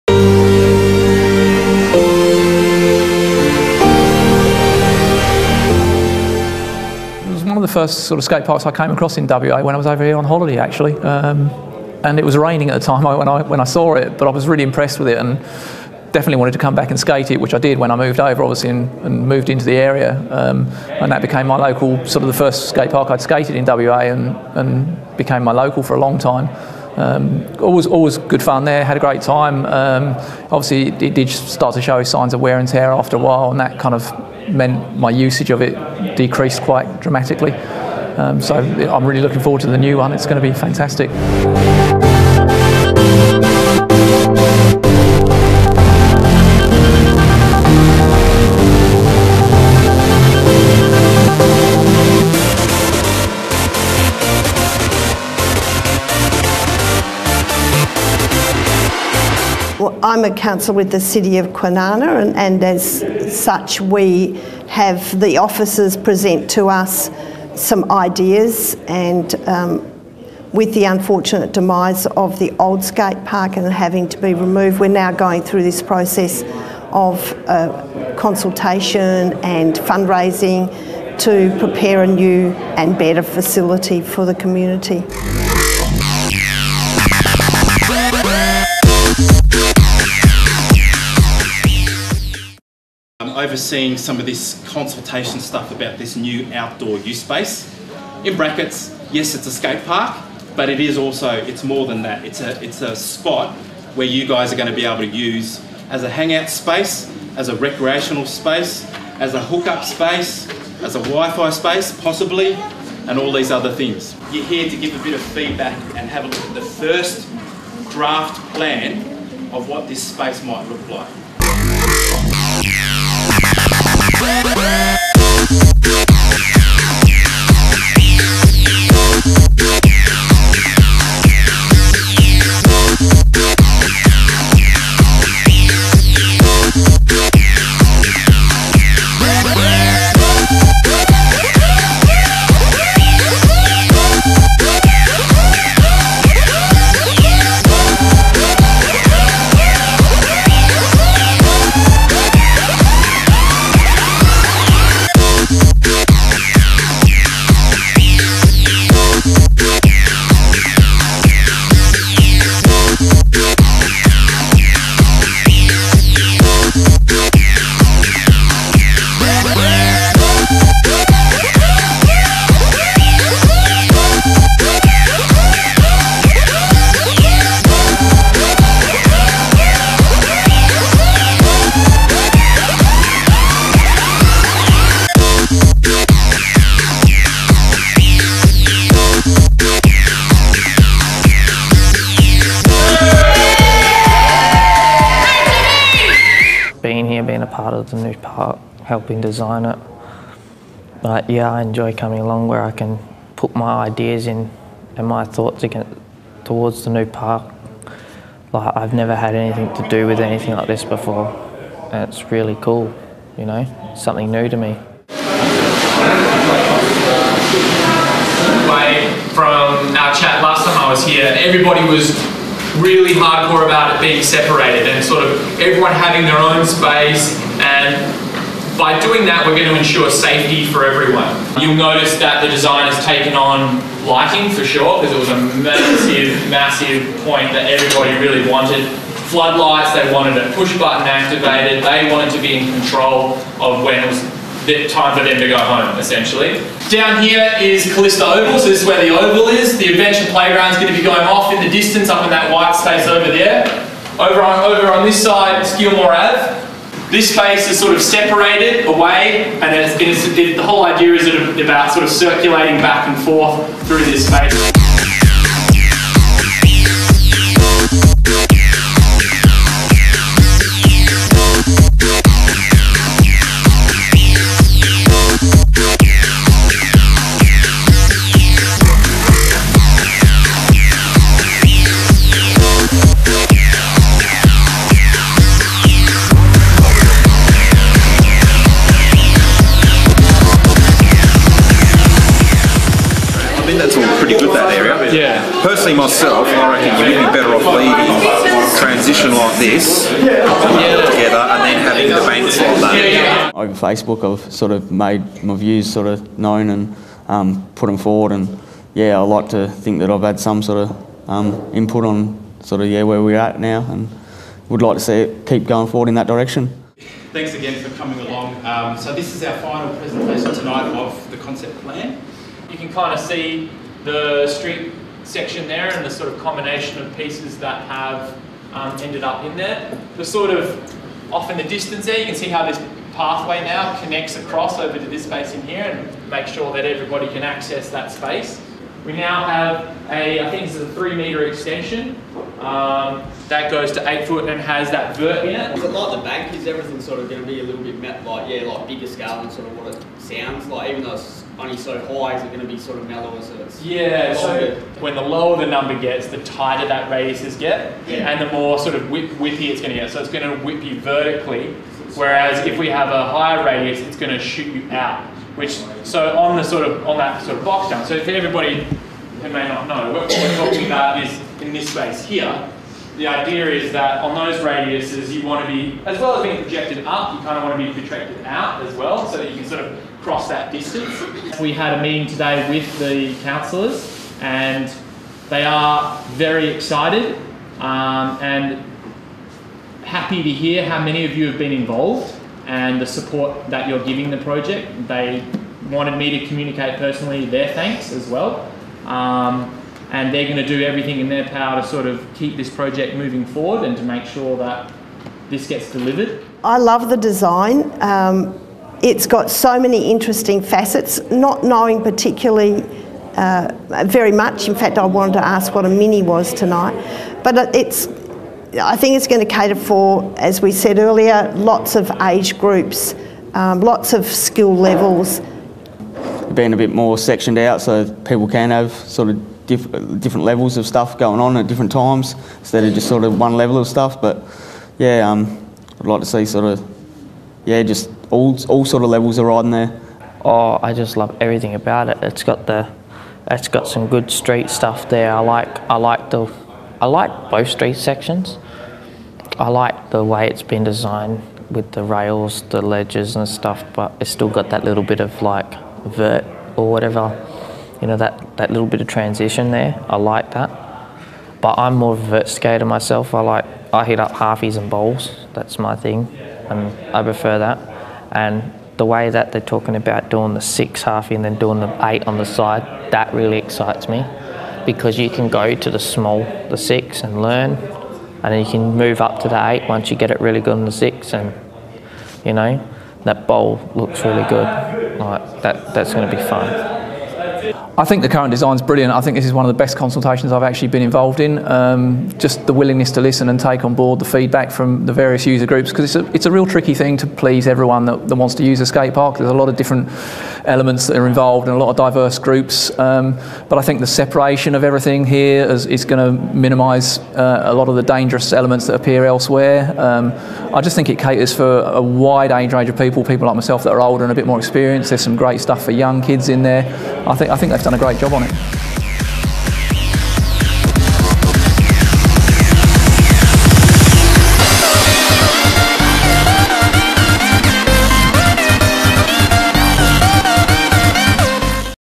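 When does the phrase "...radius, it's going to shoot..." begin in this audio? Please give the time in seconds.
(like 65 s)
363 s.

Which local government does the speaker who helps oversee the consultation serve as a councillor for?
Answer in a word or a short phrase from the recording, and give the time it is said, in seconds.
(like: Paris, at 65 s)
City of Kwinana, at 60 s.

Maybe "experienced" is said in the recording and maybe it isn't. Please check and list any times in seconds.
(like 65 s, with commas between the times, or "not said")
514 s.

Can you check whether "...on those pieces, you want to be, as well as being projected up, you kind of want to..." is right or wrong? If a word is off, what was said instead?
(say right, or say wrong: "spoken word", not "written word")
wrong: "radiuses", not "pieces".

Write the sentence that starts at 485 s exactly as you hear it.
Like that, that's going to be fun.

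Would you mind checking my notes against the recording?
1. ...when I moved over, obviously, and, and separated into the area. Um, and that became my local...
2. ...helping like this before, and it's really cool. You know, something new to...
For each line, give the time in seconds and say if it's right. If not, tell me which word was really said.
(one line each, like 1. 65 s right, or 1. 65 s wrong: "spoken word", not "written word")
1. 17 s wrong: "moved", not "separated"
2. 210 s wrong: "anything", not "helping".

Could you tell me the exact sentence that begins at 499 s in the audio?
There's a lot of different elements that are involved and a lot of diverse groups.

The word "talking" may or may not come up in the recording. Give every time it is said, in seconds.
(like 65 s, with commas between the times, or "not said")
370 s, 469 s.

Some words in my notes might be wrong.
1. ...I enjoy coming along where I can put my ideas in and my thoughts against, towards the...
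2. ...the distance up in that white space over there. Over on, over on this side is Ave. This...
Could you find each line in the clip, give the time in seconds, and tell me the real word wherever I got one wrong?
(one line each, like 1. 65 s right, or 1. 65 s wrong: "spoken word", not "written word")
1. 201 s right
2. 251 s right.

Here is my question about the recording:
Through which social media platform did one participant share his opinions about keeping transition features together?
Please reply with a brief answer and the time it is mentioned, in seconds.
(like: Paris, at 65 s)
Facebook, at 303 s.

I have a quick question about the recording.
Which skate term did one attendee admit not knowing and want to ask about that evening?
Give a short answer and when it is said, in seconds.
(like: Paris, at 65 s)
Mini, at 415 s.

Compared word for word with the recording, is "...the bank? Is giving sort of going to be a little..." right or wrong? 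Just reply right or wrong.
wrong.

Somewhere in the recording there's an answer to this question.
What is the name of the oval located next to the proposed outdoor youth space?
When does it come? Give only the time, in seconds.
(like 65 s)
247 s.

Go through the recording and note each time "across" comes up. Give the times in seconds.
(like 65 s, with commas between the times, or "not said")
8 s, 334 s.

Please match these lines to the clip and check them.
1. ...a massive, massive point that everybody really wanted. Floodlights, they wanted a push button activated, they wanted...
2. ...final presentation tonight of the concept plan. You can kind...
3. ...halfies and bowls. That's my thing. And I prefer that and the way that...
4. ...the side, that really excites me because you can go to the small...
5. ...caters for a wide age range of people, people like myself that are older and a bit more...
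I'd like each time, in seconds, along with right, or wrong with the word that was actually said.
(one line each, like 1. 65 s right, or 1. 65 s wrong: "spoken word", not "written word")
1. 235 s right
2. 319 s right
3. 464 s right
4. 472 s right
5. 511 s right.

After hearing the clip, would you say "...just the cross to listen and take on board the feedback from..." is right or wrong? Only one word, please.
wrong.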